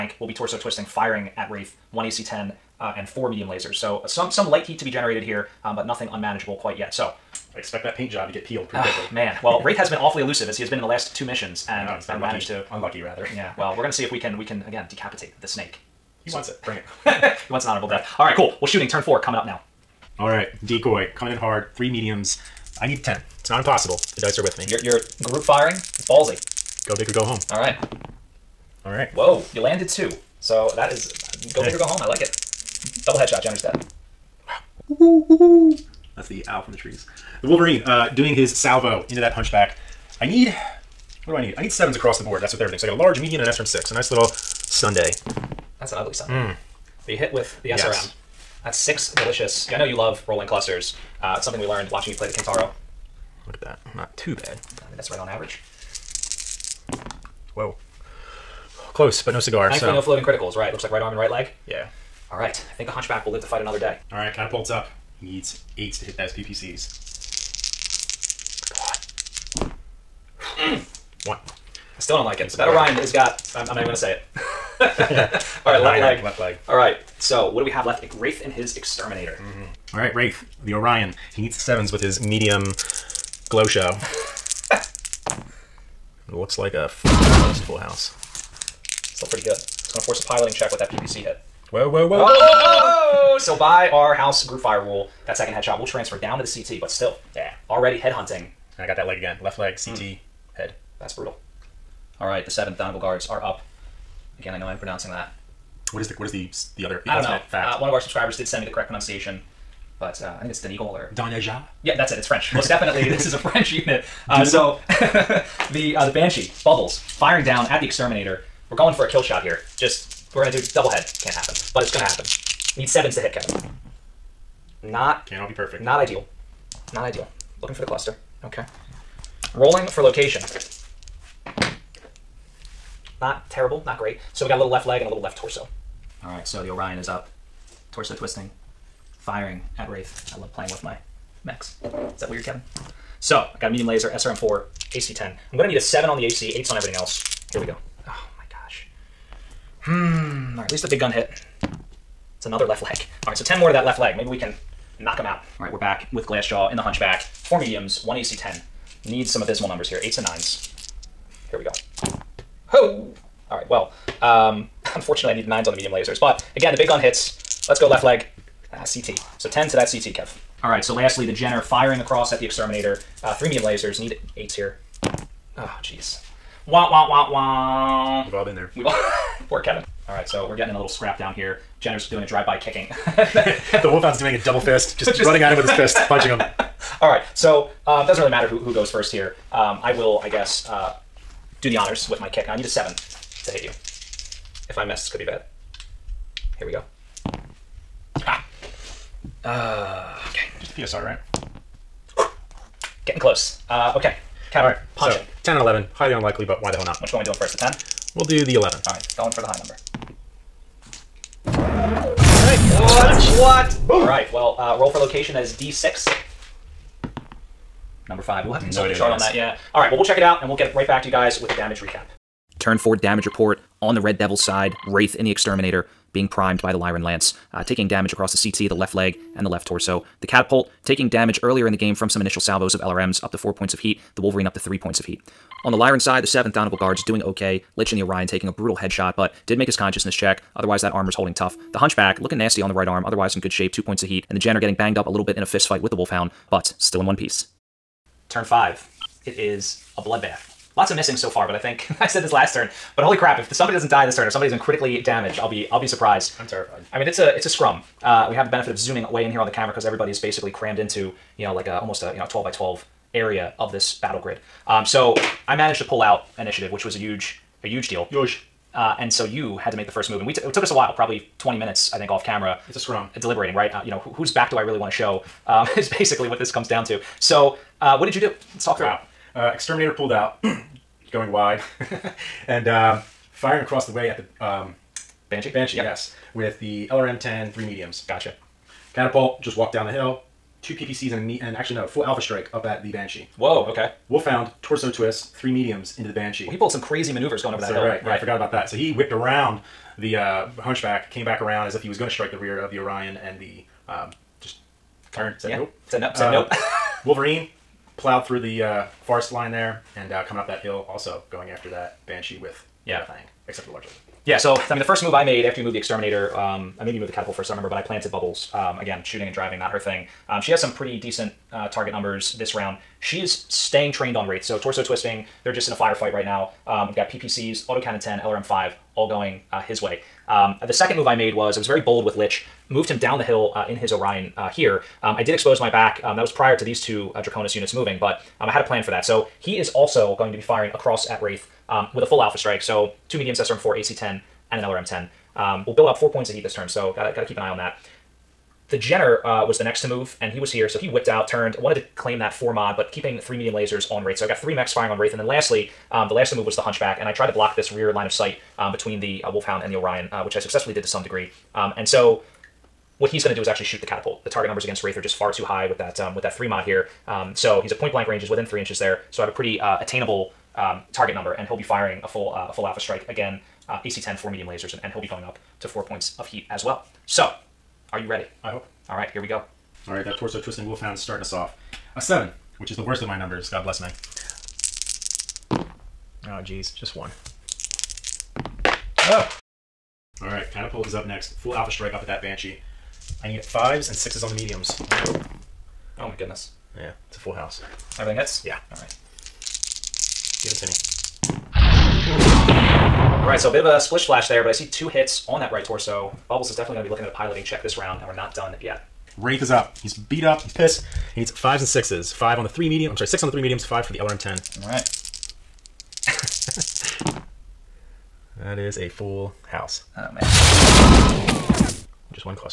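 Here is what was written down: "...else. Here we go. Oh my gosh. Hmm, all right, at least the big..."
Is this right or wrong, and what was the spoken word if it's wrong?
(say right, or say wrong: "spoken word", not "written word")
right.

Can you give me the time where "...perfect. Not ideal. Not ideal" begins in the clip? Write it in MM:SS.
02:05.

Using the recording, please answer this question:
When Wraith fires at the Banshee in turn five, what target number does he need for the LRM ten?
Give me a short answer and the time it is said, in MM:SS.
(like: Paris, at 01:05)
5, at 06:53.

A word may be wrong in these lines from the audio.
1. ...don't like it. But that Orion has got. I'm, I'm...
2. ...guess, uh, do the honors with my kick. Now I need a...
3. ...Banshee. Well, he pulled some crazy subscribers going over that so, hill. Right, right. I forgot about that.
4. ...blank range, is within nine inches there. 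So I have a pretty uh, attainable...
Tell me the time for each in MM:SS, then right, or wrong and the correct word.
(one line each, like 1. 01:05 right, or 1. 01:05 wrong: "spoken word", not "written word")
1. 01:12 right
2. 03:10 right
3. 04:56 wrong: "maneuvers", not "subscribers"
4. 06:07 wrong: "three", not "nine".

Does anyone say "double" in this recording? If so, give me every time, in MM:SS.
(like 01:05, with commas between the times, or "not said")
00:33, 02:00, 03:04.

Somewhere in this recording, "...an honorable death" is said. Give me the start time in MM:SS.
00:17.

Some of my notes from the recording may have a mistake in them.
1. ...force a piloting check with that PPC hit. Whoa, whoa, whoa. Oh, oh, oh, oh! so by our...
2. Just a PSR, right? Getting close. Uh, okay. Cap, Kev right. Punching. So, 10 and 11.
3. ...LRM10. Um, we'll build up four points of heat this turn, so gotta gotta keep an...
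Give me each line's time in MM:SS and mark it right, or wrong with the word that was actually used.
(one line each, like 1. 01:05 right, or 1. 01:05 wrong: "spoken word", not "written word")
1. 01:30 right
2. 03:20 wrong: "All", not "Kev"
3. 05:44 right.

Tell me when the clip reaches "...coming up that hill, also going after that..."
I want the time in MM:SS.
05:10.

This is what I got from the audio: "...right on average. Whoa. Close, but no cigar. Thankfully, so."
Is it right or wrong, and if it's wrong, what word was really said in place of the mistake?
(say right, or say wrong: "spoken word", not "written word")
right.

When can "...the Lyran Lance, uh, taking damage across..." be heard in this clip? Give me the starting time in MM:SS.
03:46.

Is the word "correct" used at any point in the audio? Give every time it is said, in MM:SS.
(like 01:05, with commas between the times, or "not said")
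01:48.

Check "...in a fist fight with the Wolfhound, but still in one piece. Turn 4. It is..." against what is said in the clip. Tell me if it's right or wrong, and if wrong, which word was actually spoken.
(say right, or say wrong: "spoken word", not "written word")
wrong: "5", not "4".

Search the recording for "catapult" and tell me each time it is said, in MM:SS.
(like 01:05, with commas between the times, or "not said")
01:04, 03:50, 04:48, 05:17, 06:03, 06:30.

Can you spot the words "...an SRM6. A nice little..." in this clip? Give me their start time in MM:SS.
00:43.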